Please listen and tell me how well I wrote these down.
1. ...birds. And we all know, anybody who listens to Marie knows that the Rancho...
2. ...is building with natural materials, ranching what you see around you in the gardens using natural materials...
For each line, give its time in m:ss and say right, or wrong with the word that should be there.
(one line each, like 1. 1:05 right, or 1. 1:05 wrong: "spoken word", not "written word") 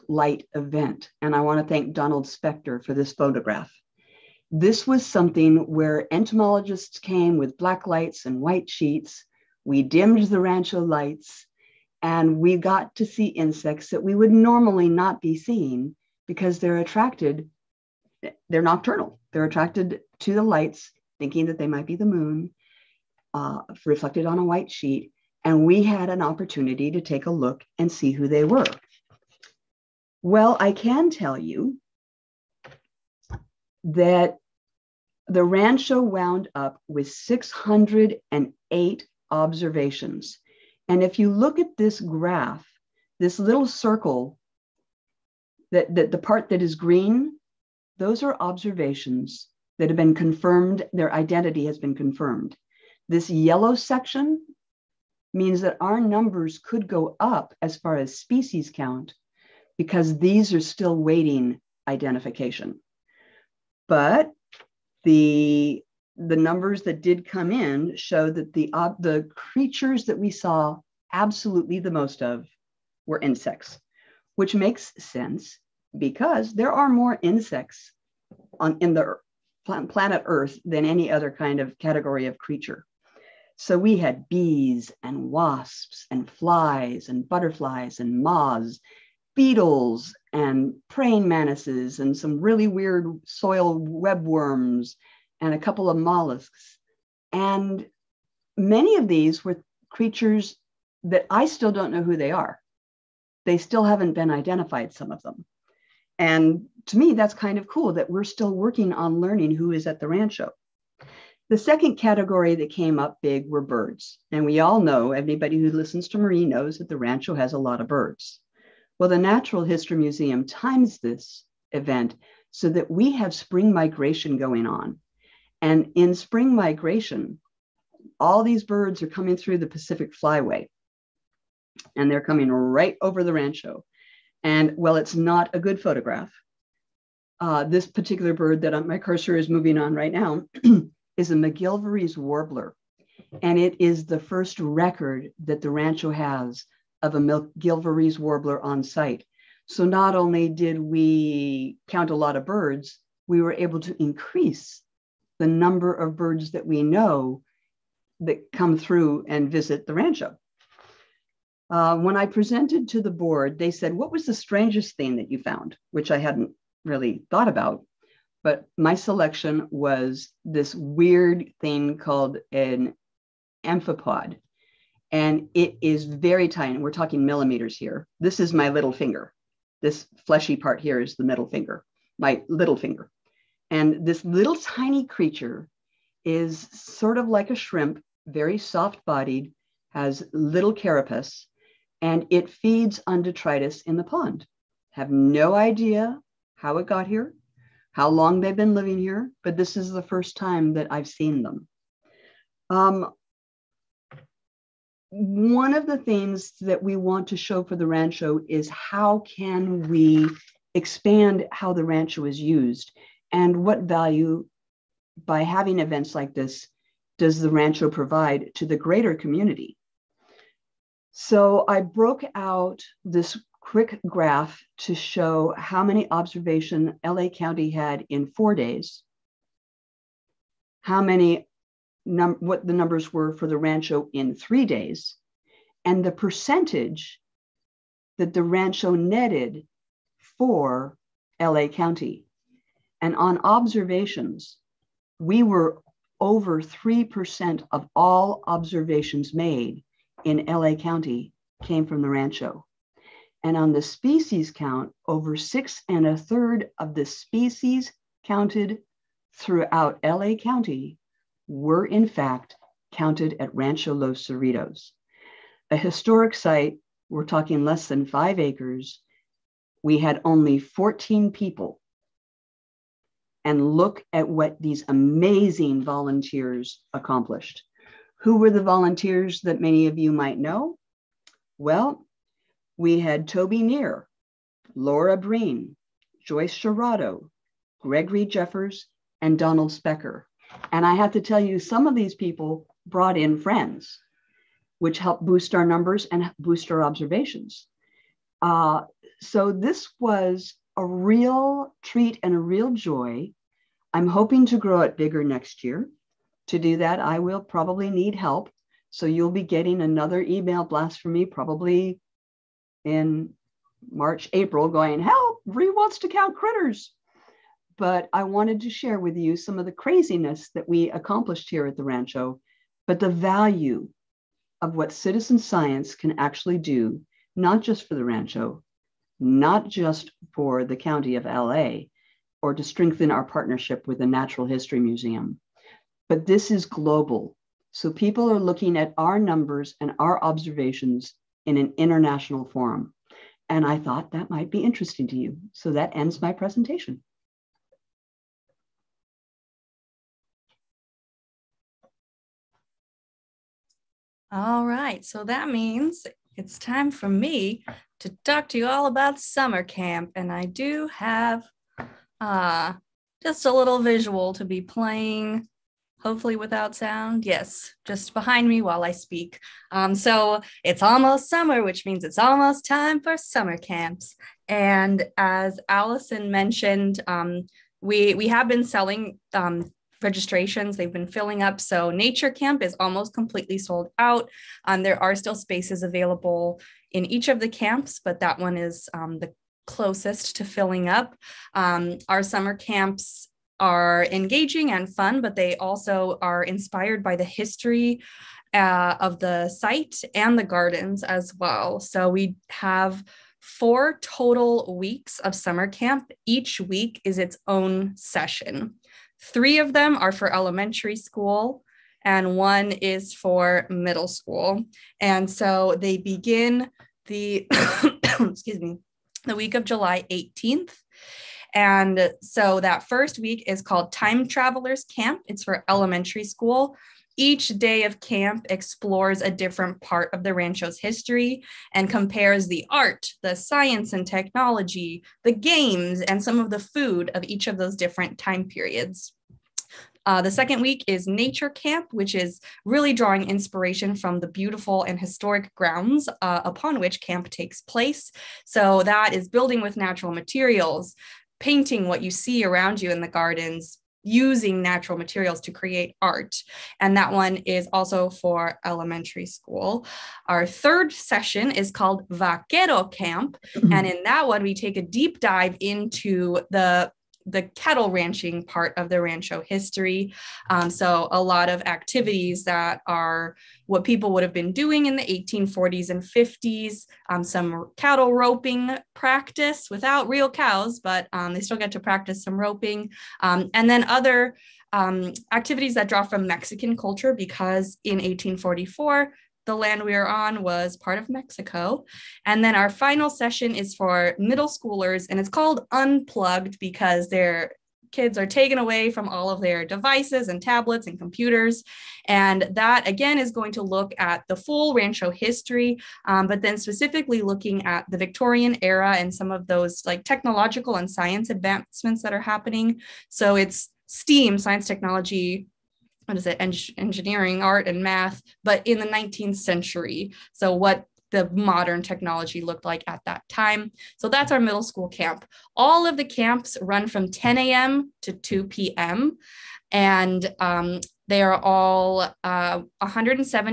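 1. 1:53 right
2. 7:29 wrong: "painting", not "ranching".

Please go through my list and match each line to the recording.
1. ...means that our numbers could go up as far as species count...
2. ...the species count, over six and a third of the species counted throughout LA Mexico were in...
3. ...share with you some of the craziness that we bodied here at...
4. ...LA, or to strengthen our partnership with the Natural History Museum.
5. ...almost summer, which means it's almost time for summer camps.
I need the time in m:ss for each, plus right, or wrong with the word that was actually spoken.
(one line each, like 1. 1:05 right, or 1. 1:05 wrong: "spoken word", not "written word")
1. 0:55 right
2. 4:13 wrong: "County", not "Mexico"
3. 5:18 wrong: "accomplished", not "bodied"
4. 5:31 right
5. 6:10 right.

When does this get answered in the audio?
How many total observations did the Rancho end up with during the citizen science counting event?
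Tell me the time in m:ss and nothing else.
0:37.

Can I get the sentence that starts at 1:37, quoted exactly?
And many of these were creatures that I still don't know who they are.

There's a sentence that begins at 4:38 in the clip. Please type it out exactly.
Who were the volunteers that many of you might know?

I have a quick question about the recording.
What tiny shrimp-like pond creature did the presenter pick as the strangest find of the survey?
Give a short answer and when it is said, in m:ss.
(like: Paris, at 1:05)
Amphipod, at 2:53.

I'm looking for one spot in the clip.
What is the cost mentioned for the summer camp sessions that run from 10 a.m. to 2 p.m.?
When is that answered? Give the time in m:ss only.
8:52.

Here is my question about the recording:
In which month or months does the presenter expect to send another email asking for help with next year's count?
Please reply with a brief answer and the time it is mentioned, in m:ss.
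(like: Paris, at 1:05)
March, April, at 5:13.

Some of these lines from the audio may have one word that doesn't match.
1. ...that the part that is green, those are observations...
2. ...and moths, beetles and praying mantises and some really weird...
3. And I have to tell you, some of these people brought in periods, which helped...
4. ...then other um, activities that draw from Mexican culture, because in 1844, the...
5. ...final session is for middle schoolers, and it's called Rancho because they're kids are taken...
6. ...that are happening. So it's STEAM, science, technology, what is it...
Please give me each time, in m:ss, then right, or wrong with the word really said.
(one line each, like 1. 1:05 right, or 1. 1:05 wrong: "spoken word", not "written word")
1. 0:45 right
2. 1:27 right
3. 4:50 wrong: "friends", not "periods"
4. 8:03 right
5. 8:12 wrong: "Unplugged", not "Rancho"
6. 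8:32 right.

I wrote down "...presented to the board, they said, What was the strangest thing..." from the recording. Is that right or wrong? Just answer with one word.
right.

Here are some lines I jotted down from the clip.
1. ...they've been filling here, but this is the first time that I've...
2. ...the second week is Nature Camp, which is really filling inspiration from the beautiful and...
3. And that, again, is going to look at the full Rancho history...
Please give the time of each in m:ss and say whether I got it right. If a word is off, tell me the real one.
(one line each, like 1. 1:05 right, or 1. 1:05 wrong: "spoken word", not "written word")
1. 3:18 wrong: "living", not "filling"
2. 7:20 wrong: "drawing", not "filling"
3. 8:22 right.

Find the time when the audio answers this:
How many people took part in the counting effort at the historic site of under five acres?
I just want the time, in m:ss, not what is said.
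4:30.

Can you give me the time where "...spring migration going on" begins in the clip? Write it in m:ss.
2:03.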